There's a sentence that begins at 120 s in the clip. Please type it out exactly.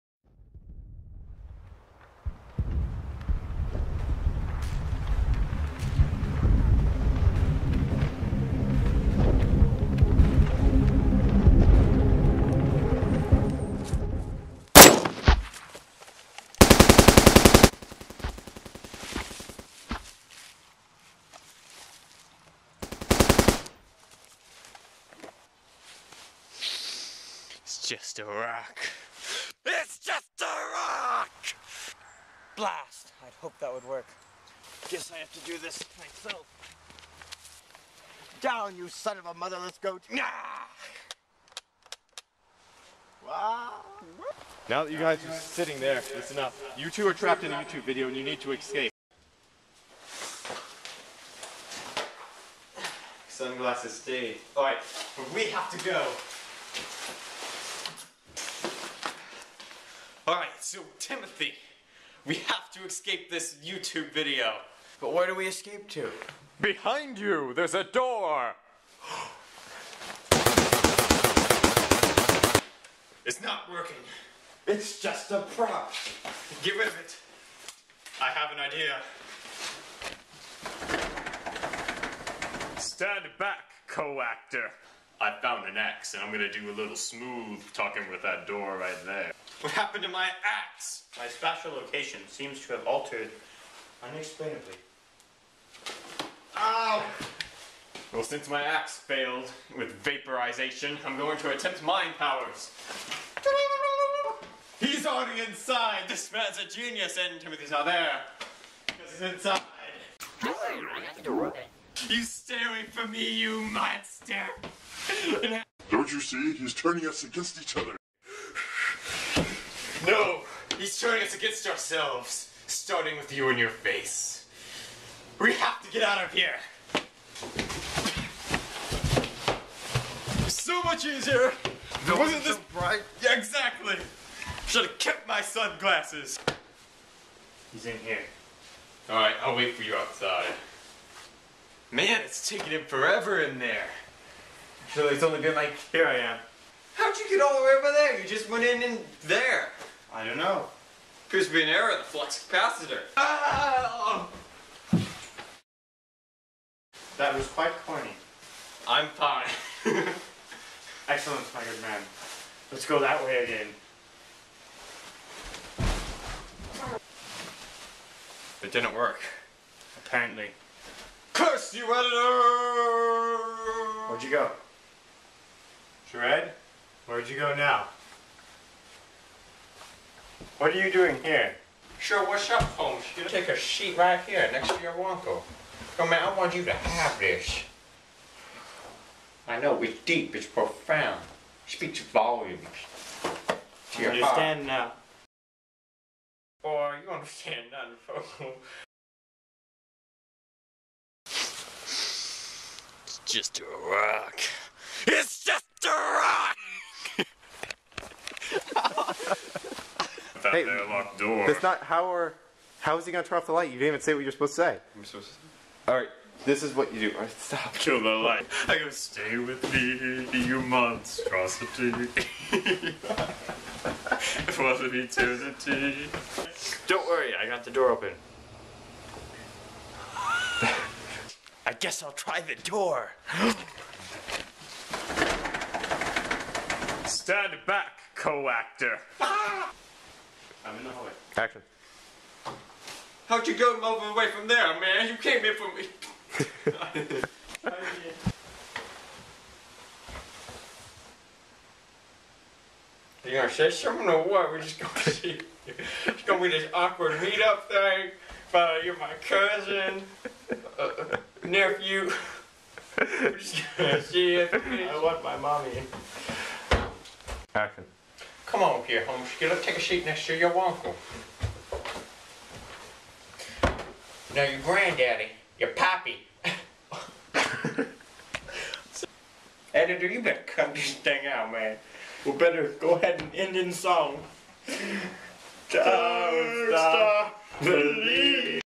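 No, he's turning us against ourselves, starting with you in your face.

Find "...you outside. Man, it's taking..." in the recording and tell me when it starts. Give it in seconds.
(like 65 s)
139 s.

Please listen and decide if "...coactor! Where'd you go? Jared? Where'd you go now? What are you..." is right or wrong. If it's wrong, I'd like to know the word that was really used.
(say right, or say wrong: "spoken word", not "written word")
wrong: "editor", not "coactor".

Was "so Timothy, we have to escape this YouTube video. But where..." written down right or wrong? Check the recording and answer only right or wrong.
right.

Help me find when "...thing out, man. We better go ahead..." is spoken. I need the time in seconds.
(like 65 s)
280 s.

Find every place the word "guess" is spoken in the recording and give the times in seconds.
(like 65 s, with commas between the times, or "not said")
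34 s, 231 s.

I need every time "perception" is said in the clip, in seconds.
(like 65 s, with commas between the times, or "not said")
not said.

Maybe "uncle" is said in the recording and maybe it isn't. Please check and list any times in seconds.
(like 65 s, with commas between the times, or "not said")
185 s, 270 s.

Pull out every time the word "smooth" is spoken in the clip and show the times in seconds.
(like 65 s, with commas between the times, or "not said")
86 s.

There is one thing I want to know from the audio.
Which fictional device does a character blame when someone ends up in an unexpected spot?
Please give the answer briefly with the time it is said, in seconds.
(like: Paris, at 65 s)
Flux capacitor, at 152 s.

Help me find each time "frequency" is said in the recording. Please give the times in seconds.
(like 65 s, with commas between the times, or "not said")
not said.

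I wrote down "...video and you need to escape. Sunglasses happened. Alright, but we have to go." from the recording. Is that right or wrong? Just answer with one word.
wrong.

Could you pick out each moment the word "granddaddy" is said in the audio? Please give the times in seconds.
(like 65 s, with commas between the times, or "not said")
274 s.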